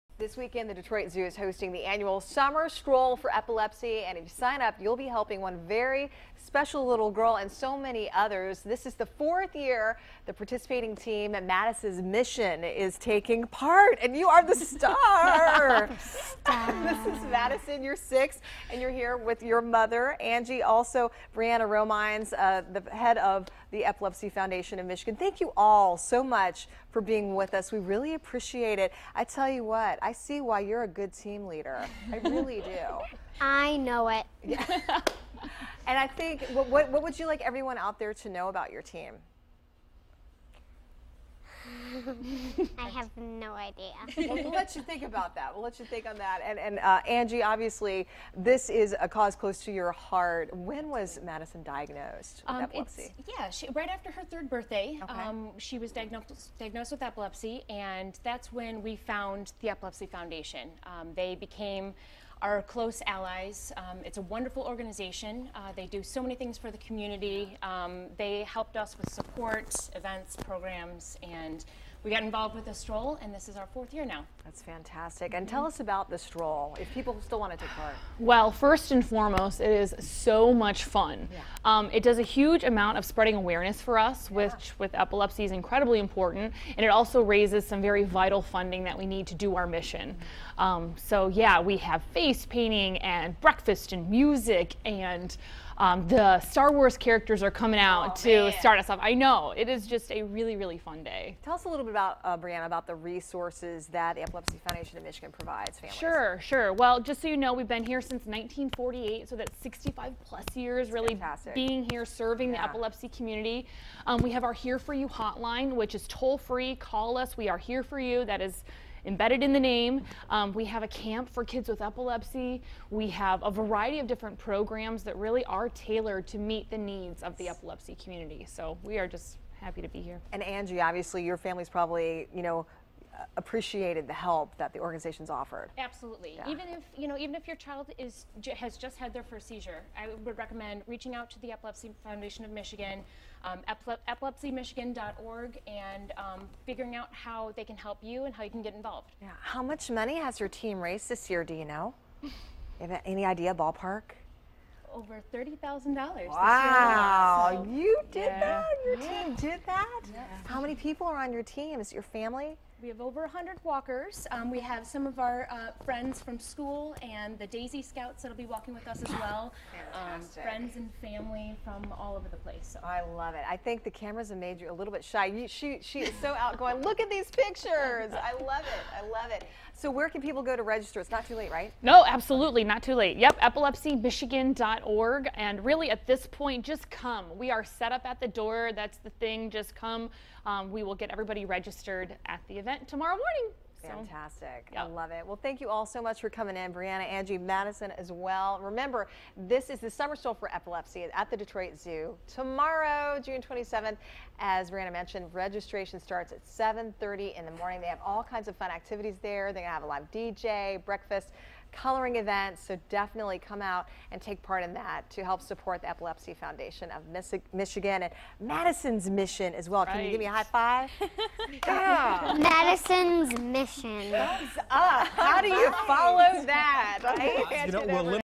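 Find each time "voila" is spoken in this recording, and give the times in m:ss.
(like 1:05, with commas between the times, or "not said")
not said.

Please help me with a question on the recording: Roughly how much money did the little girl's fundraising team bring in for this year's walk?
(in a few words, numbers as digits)
over $30,000.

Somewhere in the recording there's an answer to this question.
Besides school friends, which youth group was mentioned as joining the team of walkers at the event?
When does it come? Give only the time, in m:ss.
2:47.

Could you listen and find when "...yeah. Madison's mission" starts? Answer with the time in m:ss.
3:41.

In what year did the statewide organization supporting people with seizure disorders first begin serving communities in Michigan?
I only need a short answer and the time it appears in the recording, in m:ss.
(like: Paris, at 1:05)
1948, at 1:48.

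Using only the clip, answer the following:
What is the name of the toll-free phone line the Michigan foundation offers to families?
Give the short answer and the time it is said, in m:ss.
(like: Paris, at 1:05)
Here For You hotline, at 1:54.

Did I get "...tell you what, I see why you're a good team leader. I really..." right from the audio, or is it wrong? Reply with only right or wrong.
right.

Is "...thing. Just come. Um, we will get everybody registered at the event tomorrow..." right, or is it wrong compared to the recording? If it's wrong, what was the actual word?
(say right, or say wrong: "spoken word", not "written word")
right.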